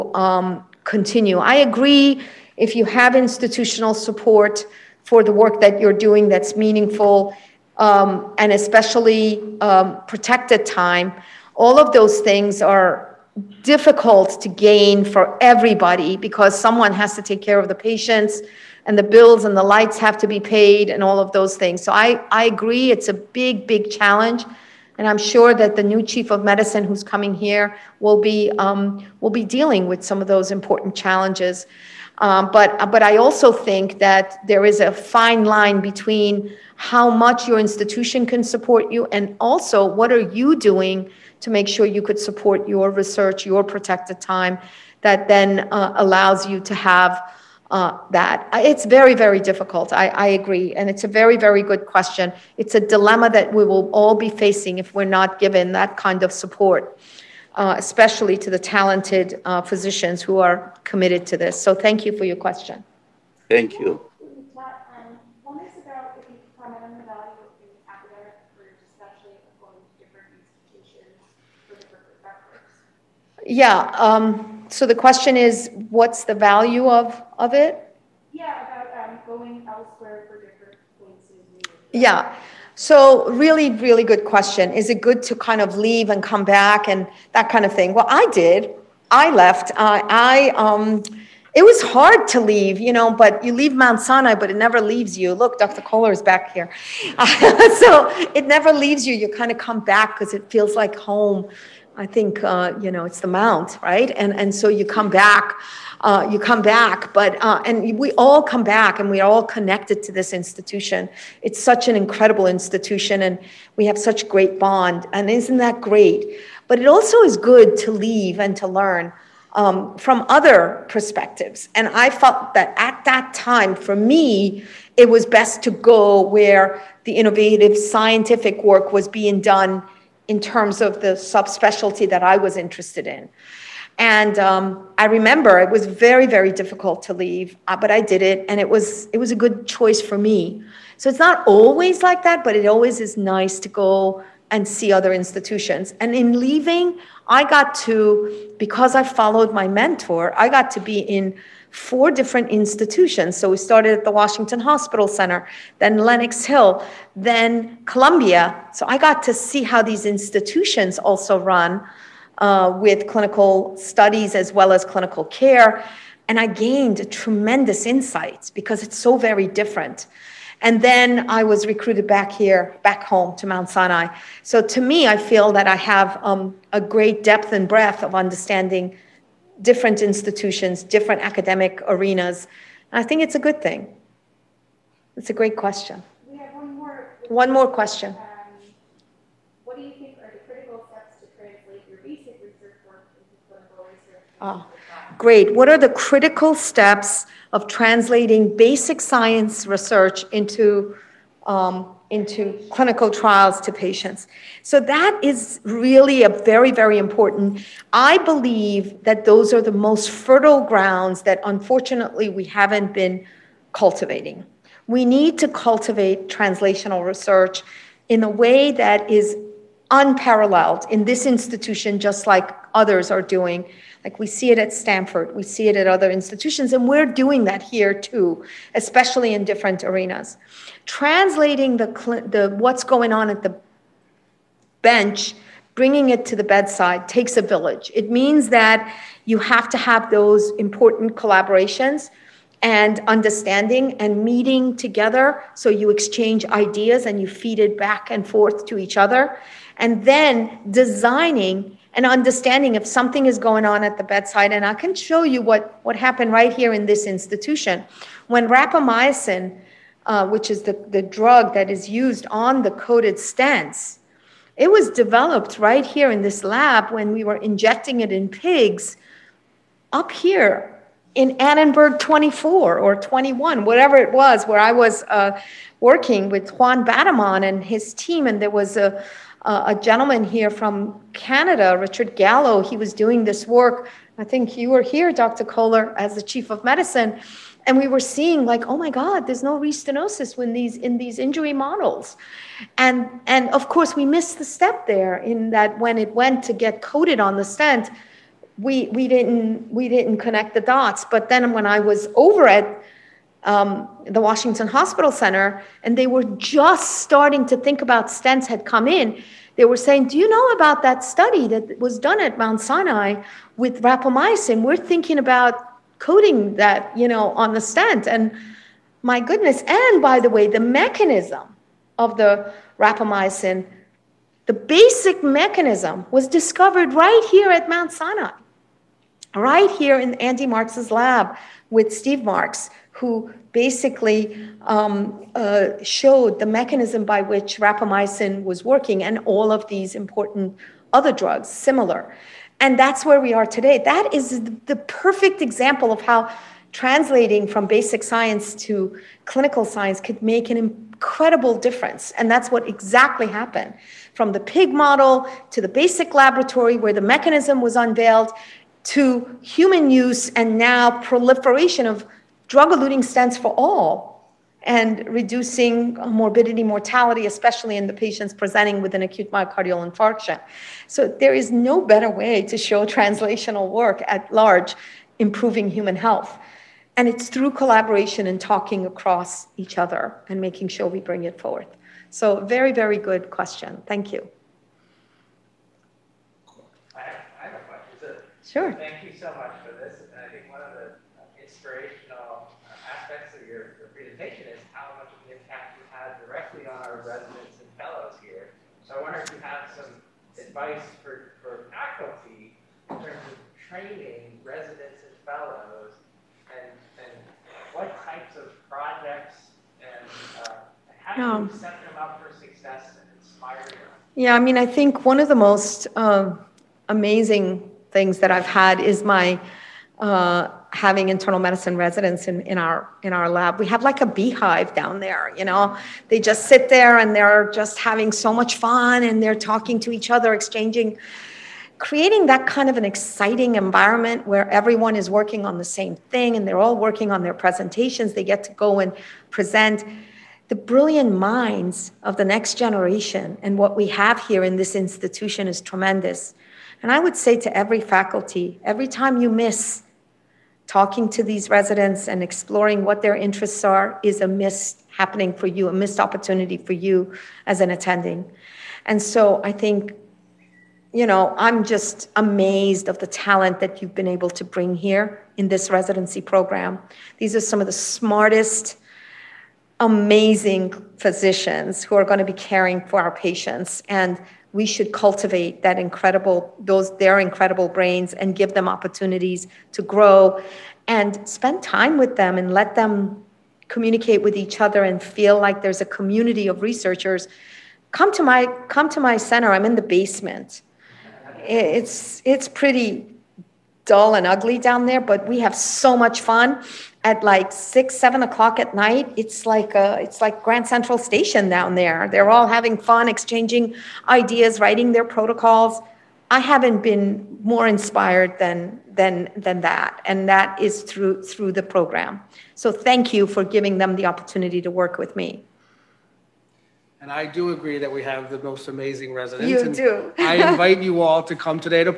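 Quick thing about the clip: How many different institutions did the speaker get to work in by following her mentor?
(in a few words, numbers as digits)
4.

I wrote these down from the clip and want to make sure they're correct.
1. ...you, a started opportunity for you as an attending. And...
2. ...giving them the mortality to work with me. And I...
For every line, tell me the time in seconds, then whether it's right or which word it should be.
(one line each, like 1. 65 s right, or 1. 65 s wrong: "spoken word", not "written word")
1. 455 s wrong: "missed", not "started"
2. 513 s wrong: "opportunity", not "mortality".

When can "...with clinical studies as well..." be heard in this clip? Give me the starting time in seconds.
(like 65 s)
162 s.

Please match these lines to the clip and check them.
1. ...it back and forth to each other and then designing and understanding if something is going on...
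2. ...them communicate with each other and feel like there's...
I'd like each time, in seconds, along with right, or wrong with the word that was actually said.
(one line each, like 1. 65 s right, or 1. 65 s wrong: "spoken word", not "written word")
1. 247 s right
2. 482 s right.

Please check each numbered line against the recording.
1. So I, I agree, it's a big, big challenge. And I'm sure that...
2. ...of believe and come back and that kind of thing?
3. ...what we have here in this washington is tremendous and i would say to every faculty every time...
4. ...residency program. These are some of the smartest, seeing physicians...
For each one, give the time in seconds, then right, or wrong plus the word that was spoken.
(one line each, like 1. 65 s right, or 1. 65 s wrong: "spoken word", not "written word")
1. 21 s right
2. 85 s wrong: "leave", not "believe"
3. 443 s wrong: "institution", not "washington"
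4. 465 s wrong: "amazing", not "seeing".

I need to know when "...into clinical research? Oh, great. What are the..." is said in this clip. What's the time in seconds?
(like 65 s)
193 s.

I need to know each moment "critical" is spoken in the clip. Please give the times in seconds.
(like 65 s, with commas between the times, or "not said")
190 s, 195 s.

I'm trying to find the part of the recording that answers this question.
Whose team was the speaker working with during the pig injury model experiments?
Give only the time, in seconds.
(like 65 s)
276 s.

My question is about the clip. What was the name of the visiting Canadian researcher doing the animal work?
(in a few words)
Richard Gallo.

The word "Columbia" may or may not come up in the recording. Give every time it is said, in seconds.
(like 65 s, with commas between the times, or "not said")
157 s.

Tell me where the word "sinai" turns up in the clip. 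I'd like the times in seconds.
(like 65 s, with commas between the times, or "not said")
94 s, 173 s, 312 s, 327 s.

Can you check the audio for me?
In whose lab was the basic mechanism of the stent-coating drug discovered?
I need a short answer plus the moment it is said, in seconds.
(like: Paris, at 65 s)
Andy Marks, at 330 s.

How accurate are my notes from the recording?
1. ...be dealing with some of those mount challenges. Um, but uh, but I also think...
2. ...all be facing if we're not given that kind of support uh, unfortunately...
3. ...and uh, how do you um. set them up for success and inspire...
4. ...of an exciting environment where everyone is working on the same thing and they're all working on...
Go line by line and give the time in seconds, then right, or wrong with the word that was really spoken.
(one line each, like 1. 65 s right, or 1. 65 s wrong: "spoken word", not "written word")
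1. 29 s wrong: "important", not "mount"
2. 53 s wrong: "especially", not "unfortunately"
3. 409 s right
4. 432 s right.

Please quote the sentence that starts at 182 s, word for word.
I think it's a good thing.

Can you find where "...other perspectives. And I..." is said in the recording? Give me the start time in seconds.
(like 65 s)
120 s.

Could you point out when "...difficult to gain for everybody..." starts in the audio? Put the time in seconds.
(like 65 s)
13 s.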